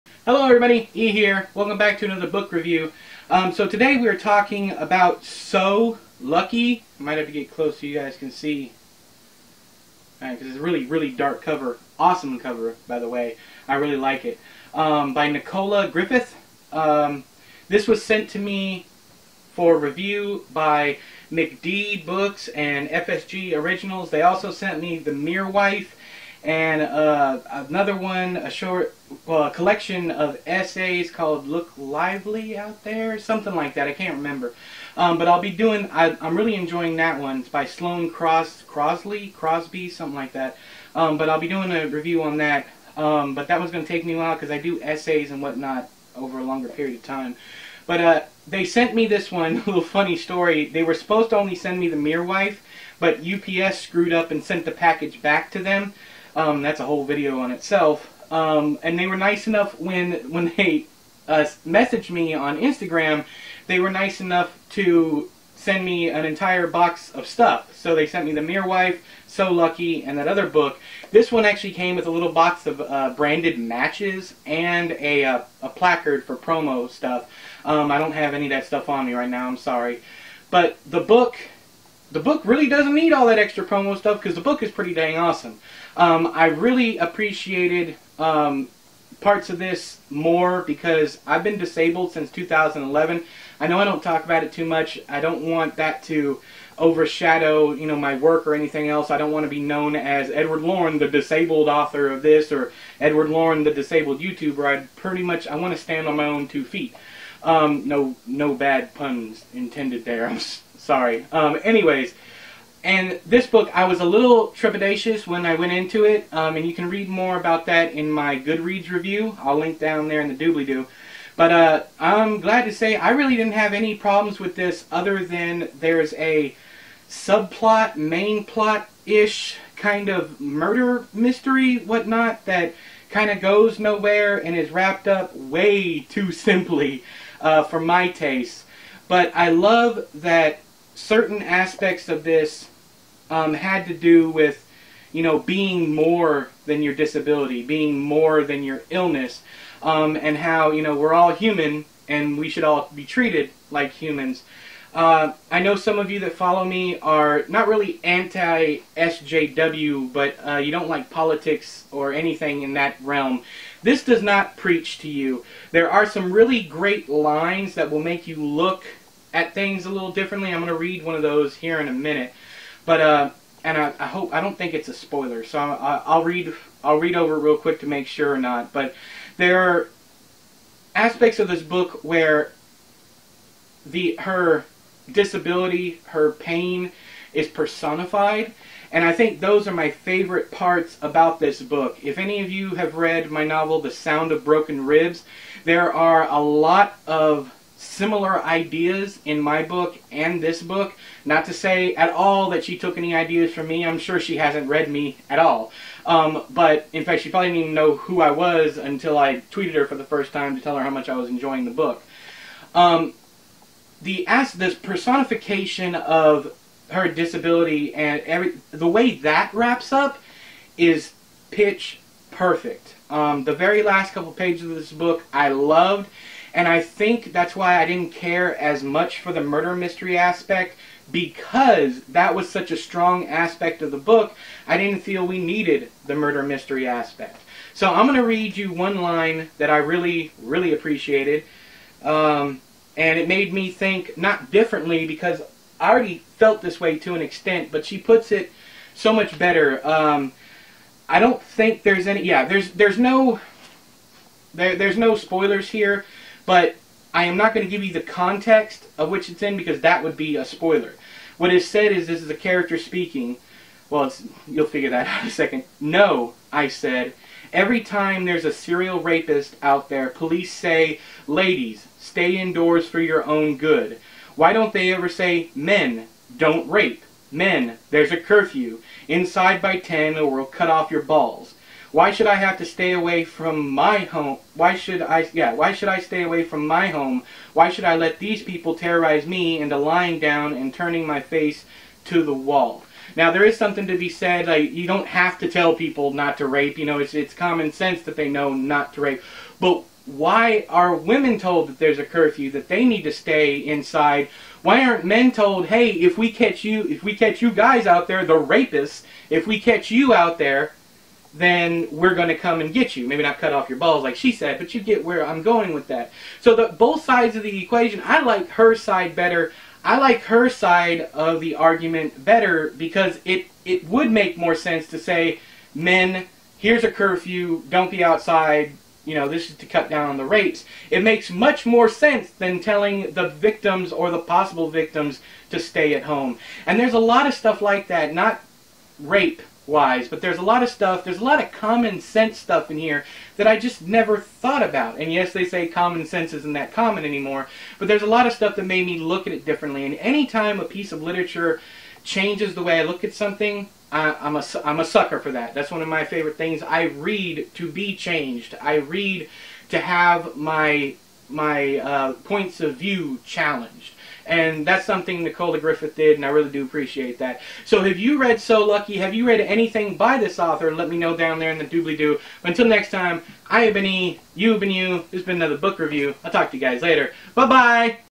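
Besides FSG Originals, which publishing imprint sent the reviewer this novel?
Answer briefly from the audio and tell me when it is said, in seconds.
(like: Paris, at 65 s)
MCD Books, at 21 s.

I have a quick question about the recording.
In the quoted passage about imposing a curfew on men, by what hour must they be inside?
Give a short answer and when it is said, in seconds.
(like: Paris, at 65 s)
10, at 279 s.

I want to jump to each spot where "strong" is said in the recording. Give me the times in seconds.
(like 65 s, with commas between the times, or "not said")
232 s.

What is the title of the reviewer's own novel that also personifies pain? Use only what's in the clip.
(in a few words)
The Sound of Broken Ribs.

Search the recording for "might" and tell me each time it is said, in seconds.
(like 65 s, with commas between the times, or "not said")
7 s.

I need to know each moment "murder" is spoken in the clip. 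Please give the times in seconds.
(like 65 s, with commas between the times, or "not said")
130 s, 229 s, 236 s.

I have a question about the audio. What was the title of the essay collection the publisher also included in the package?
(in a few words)
Look Lively Out There.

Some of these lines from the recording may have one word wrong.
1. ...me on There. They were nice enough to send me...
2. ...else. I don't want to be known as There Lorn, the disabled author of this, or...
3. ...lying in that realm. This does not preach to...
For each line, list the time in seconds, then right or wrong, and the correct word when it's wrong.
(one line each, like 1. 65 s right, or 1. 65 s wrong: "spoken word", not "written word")
1. 62 s wrong: "Instagram", not "There"
2. 98 s wrong: "Edward", not "There"
3. 162 s wrong: "anything", not "lying".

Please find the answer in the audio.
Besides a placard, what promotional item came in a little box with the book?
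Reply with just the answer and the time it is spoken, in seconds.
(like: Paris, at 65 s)
branded matches, at 73 s.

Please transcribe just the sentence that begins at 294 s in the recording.
Like, you don't have to tell people not to rape.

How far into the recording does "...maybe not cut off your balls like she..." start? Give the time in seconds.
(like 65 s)
313 s.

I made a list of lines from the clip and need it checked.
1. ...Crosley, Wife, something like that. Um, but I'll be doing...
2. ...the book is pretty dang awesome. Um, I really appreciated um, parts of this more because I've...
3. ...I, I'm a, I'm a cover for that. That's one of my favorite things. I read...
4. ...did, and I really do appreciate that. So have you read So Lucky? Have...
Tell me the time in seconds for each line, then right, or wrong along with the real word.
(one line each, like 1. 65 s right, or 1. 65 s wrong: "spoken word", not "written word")
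1. 38 s wrong: "Crosby", not "Wife"
2. 84 s right
3. 353 s wrong: "sucker", not "cover"
4. 365 s right.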